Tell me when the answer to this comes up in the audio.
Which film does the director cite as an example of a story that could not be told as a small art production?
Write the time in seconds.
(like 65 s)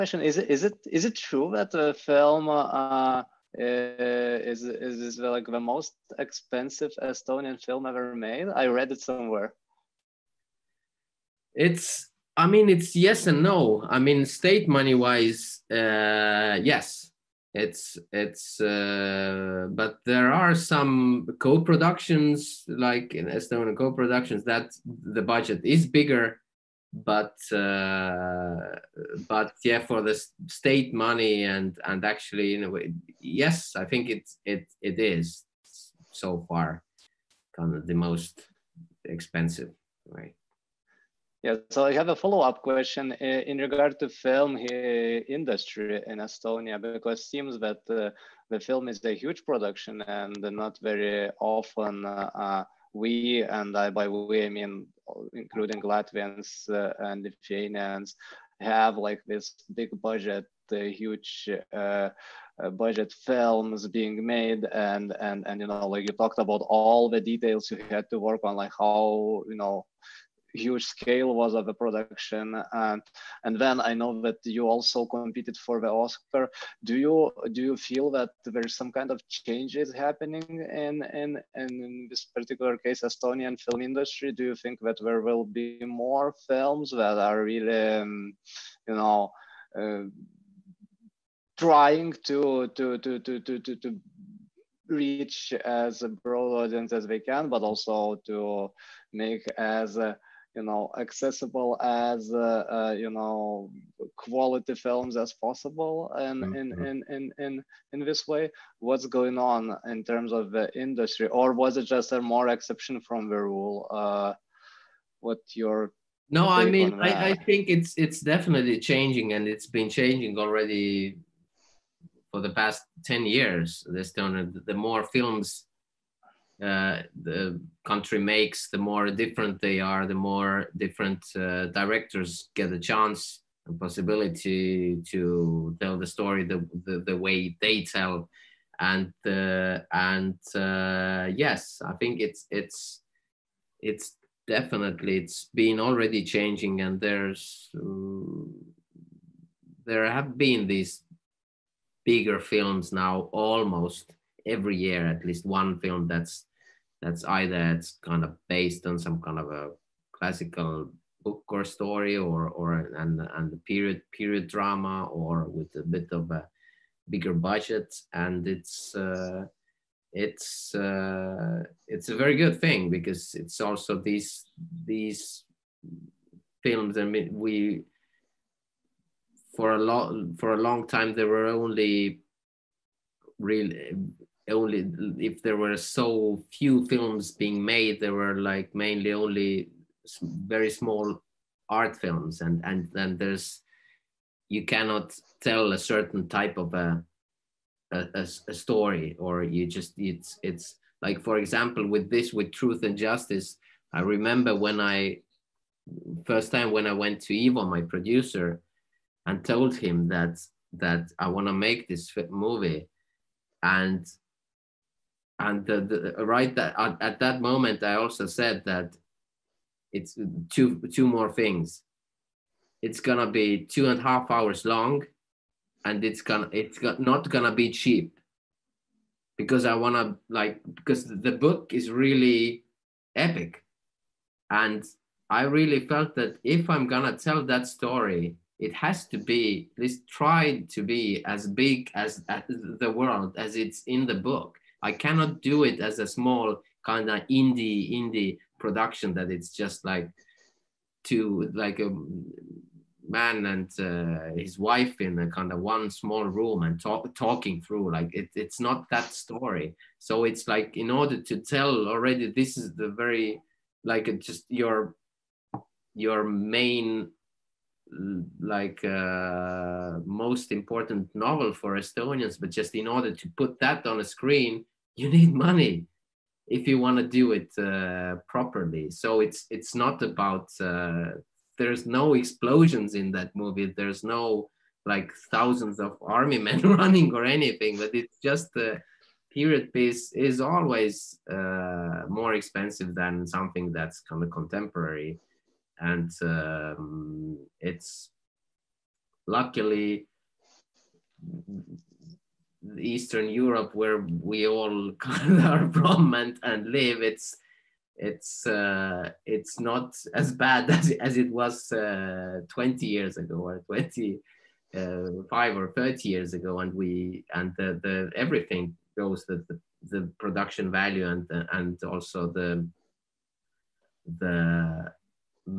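202 s.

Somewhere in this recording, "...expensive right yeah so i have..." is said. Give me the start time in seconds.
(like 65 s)
39 s.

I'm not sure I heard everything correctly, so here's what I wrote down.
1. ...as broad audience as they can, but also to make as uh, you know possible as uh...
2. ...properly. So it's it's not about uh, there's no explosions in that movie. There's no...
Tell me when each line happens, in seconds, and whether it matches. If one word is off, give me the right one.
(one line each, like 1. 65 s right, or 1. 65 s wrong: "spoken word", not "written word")
1. 95 s wrong: "accessible", not "possible"
2. 278 s right.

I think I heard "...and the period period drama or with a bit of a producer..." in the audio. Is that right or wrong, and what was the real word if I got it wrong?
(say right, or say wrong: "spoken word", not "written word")
wrong: "bigger", not "producer".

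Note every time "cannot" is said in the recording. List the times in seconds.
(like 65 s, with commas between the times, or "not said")
194 s, 244 s.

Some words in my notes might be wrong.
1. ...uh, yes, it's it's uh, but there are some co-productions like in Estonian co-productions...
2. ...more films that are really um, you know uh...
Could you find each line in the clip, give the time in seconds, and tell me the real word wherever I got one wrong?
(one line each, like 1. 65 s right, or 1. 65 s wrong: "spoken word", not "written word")
1. 15 s right
2. 85 s right.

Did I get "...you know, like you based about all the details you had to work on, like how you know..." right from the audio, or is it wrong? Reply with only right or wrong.
wrong.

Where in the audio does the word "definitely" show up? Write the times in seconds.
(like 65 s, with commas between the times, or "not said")
118 s, 144 s.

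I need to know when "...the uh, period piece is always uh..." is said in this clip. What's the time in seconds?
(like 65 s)
288 s.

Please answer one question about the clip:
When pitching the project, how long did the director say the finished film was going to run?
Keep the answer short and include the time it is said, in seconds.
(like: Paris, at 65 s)
two and a half hours, at 223 s.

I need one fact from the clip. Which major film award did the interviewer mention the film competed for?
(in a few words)
the Oscar.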